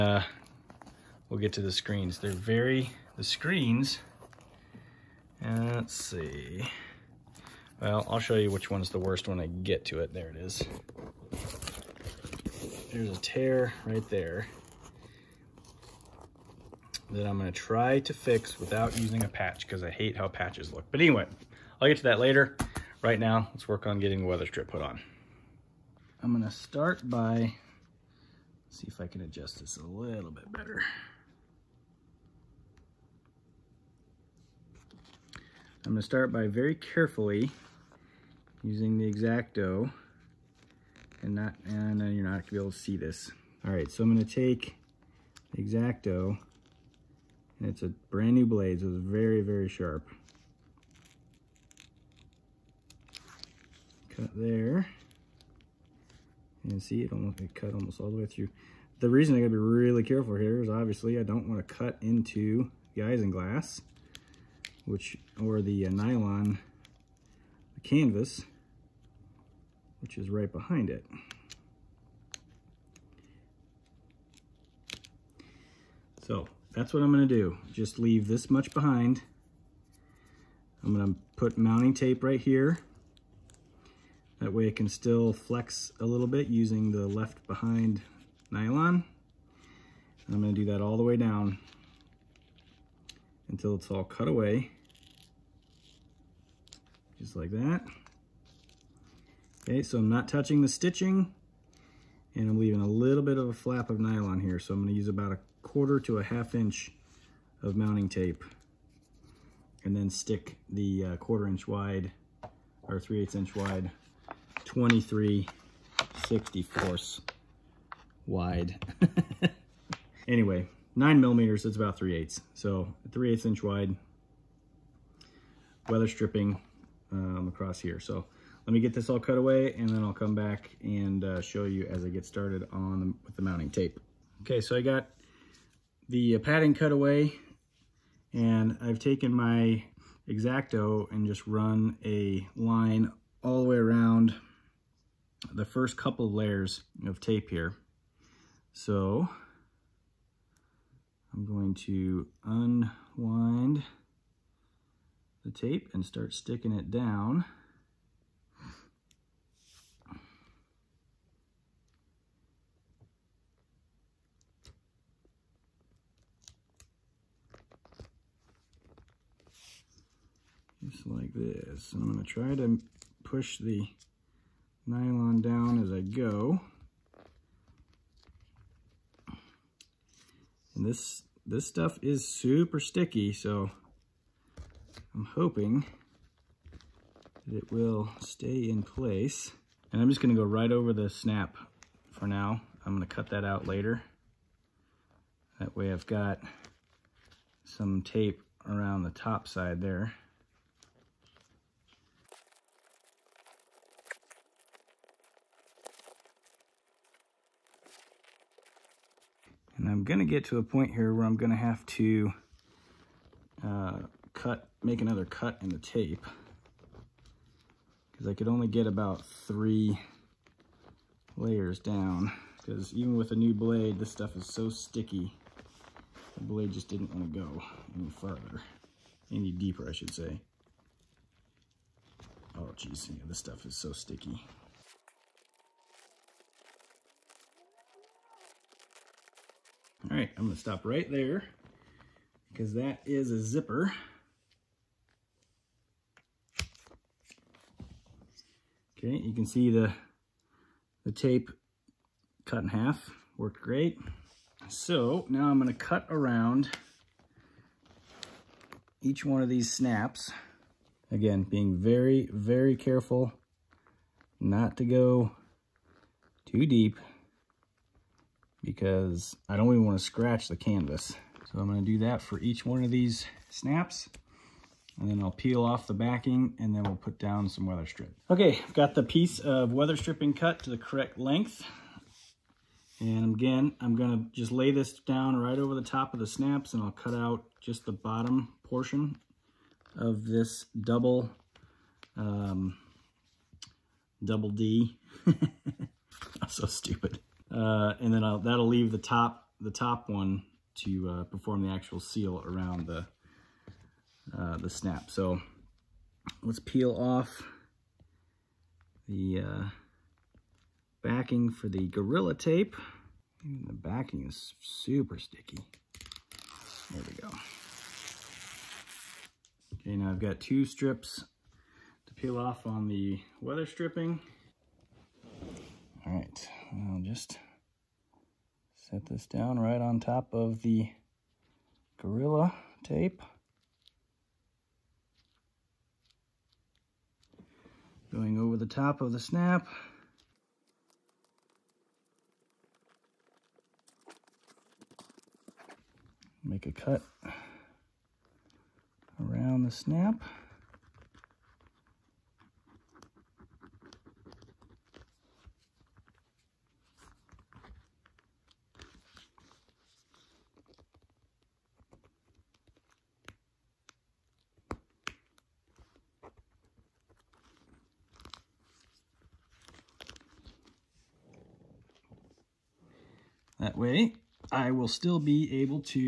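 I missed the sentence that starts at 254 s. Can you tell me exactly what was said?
So now I'm gonna cut around each one of these snaps.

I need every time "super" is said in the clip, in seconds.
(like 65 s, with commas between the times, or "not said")
182 s, 314 s.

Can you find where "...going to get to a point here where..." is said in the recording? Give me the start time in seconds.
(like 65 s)
210 s.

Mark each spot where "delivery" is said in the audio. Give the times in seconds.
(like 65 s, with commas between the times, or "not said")
not said.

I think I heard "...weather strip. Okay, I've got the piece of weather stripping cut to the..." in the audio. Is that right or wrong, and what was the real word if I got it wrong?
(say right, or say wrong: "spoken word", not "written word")
right.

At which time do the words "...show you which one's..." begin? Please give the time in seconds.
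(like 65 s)
8 s.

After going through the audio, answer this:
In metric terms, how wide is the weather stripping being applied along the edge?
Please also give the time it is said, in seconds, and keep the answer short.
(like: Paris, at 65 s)
9 millimeters, at 120 s.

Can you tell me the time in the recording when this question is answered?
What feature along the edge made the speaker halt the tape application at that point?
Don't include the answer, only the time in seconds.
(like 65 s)
243 s.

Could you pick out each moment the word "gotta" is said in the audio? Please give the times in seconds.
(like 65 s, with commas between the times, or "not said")
59 s.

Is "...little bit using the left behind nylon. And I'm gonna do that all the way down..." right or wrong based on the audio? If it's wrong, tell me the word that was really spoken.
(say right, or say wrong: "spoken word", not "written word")
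right.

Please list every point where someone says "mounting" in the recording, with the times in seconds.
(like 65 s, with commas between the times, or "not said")
81 s, 107 s, 133 s.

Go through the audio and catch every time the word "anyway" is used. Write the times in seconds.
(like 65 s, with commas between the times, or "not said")
21 s, 120 s.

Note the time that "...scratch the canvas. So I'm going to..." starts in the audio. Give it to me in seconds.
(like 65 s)
270 s.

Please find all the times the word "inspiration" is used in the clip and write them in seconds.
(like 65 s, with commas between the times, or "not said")
not said.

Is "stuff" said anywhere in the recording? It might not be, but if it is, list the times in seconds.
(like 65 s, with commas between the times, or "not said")
181 s, 224 s, 233 s.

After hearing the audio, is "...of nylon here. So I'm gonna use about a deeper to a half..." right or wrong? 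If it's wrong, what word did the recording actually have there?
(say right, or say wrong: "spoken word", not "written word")
wrong: "quarter", not "deeper".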